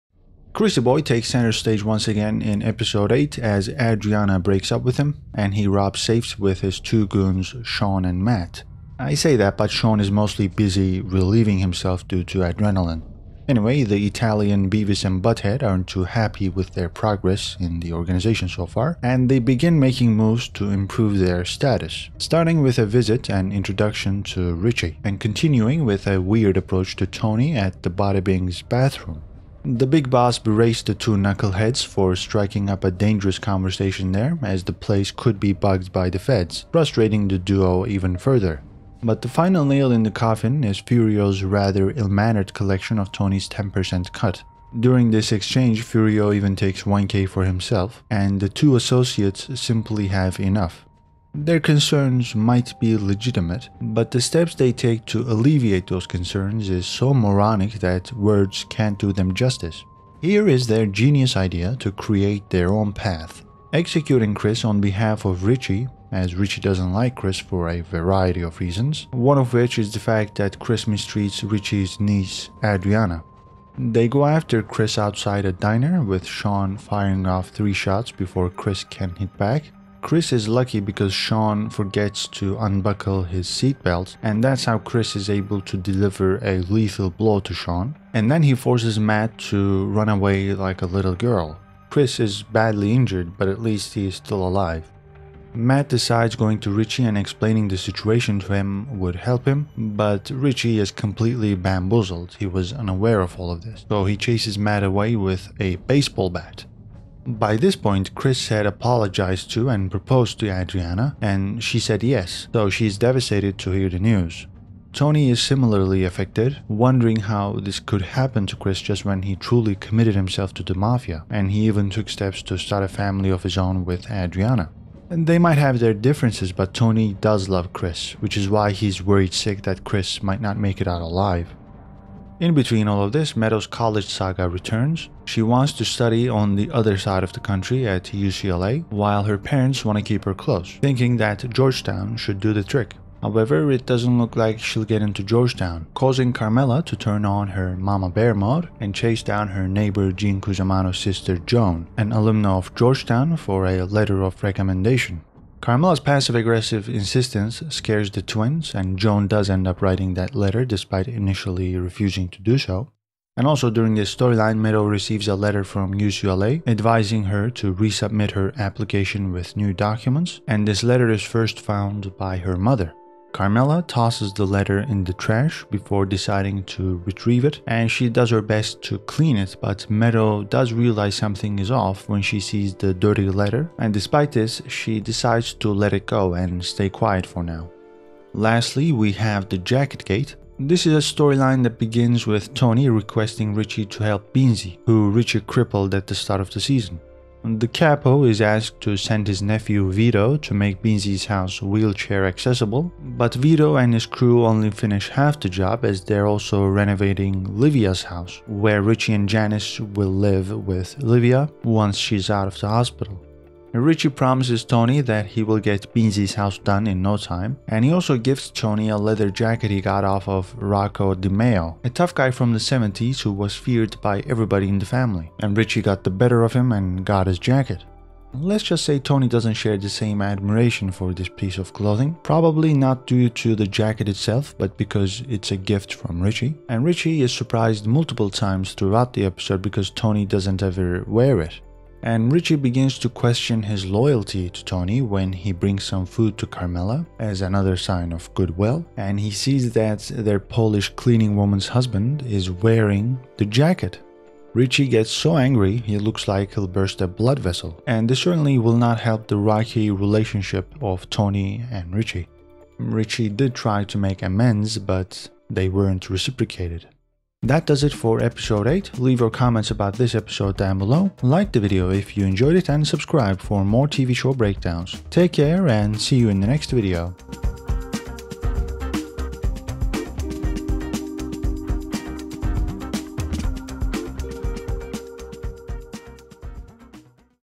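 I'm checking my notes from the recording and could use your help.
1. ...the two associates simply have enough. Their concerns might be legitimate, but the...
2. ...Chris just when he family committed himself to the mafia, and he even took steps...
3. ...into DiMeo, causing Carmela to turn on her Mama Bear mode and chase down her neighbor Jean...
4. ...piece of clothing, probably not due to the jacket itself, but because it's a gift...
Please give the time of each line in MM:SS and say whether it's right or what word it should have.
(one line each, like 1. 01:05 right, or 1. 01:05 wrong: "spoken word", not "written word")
1. 00:48 right
2. 01:58 wrong: "truly", not "family"
3. 02:25 wrong: "Georgetown", not "DiMeo"
4. 03:51 right.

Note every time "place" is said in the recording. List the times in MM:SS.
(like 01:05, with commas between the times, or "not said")
00:34.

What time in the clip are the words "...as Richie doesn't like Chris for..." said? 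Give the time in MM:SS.
01:06.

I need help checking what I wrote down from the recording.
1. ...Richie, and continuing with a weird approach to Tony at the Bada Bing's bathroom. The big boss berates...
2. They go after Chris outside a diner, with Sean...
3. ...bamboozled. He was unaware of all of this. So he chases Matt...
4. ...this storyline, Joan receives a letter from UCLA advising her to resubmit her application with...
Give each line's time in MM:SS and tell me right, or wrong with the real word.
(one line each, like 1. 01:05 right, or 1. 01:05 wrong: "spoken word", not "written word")
1. 00:24 right
2. 01:13 right
3. 01:41 right
4. 02:43 wrong: "Meadow", not "Joan".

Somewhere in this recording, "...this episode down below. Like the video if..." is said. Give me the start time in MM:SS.
04:29.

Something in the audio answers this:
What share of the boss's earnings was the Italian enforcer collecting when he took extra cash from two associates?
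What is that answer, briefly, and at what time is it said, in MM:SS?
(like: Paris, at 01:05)
10%, at 00:43.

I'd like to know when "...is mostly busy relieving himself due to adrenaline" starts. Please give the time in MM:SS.
00:10.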